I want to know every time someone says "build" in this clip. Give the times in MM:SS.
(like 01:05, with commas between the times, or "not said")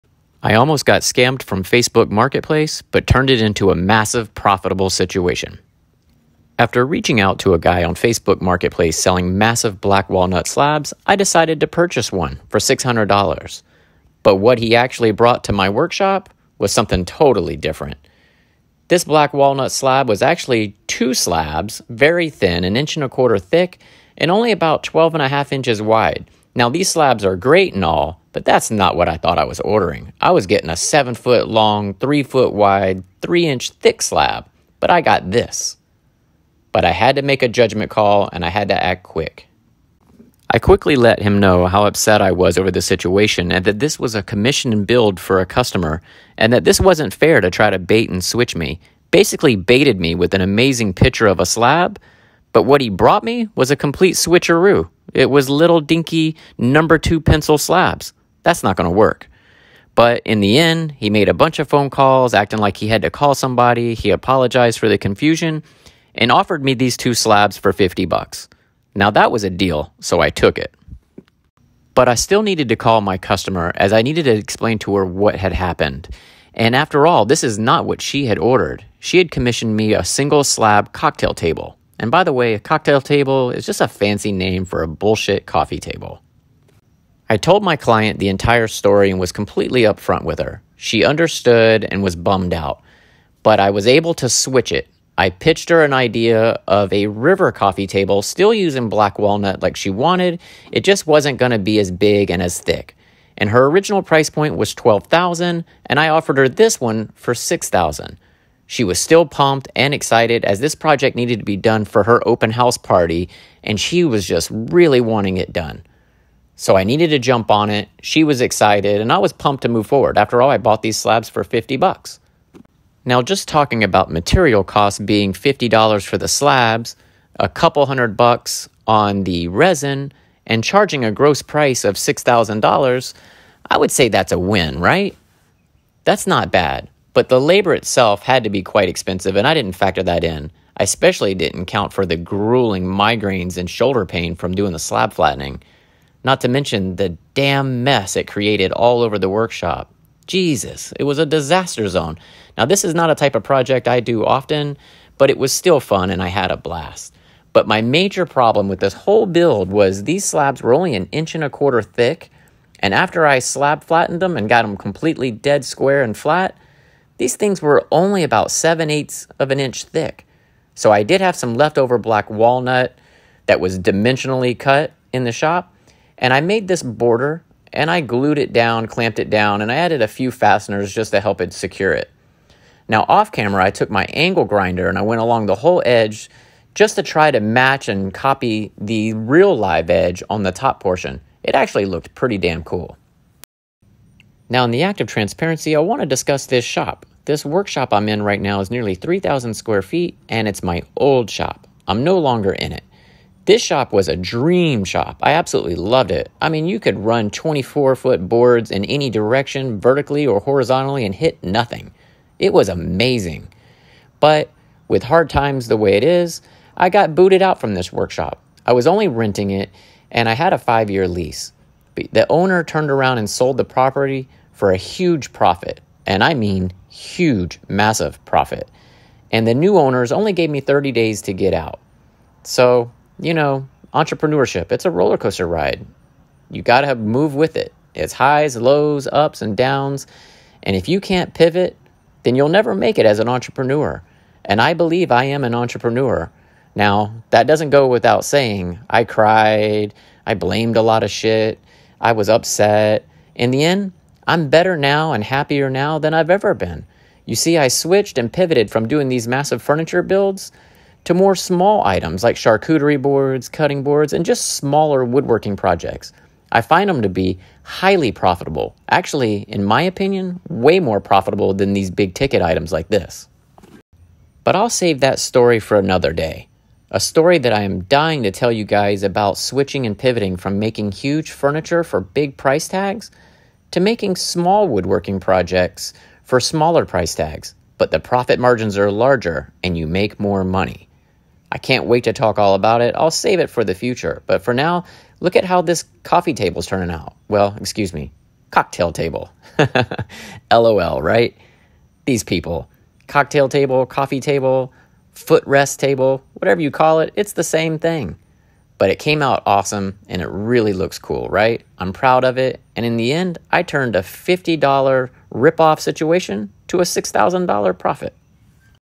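00:44, 02:39, 04:20.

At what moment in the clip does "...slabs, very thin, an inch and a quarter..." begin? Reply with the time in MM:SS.
00:21.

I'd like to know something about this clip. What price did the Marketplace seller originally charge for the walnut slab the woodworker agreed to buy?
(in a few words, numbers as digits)
$600.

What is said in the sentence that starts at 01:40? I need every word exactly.
It just wasn't going to be as big and as thick.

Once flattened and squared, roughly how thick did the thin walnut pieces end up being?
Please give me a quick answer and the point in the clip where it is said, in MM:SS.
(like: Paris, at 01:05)
7/8 inch, at 02:48.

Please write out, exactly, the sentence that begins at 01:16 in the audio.
And after all, this is not what she had ordered.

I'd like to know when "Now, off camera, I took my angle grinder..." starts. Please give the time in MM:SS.
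03:02.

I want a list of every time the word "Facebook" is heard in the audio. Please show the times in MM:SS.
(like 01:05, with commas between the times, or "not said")
00:01, 00:07.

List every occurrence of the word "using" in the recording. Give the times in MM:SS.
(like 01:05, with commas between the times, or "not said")
01:38.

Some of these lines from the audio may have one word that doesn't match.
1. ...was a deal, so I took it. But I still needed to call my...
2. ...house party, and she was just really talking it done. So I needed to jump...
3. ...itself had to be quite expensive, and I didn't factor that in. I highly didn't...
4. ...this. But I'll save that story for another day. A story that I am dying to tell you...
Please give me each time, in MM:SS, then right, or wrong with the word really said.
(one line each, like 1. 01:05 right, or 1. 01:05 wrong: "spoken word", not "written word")
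1. 01:09 right
2. 01:52 wrong: "wanting", not "talking"
3. 02:17 wrong: "especially", not "highly"
4. 04:32 right.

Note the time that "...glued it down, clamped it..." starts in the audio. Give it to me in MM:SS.
02:58.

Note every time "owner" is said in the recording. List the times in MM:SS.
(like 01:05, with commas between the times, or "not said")
03:42, 03:49.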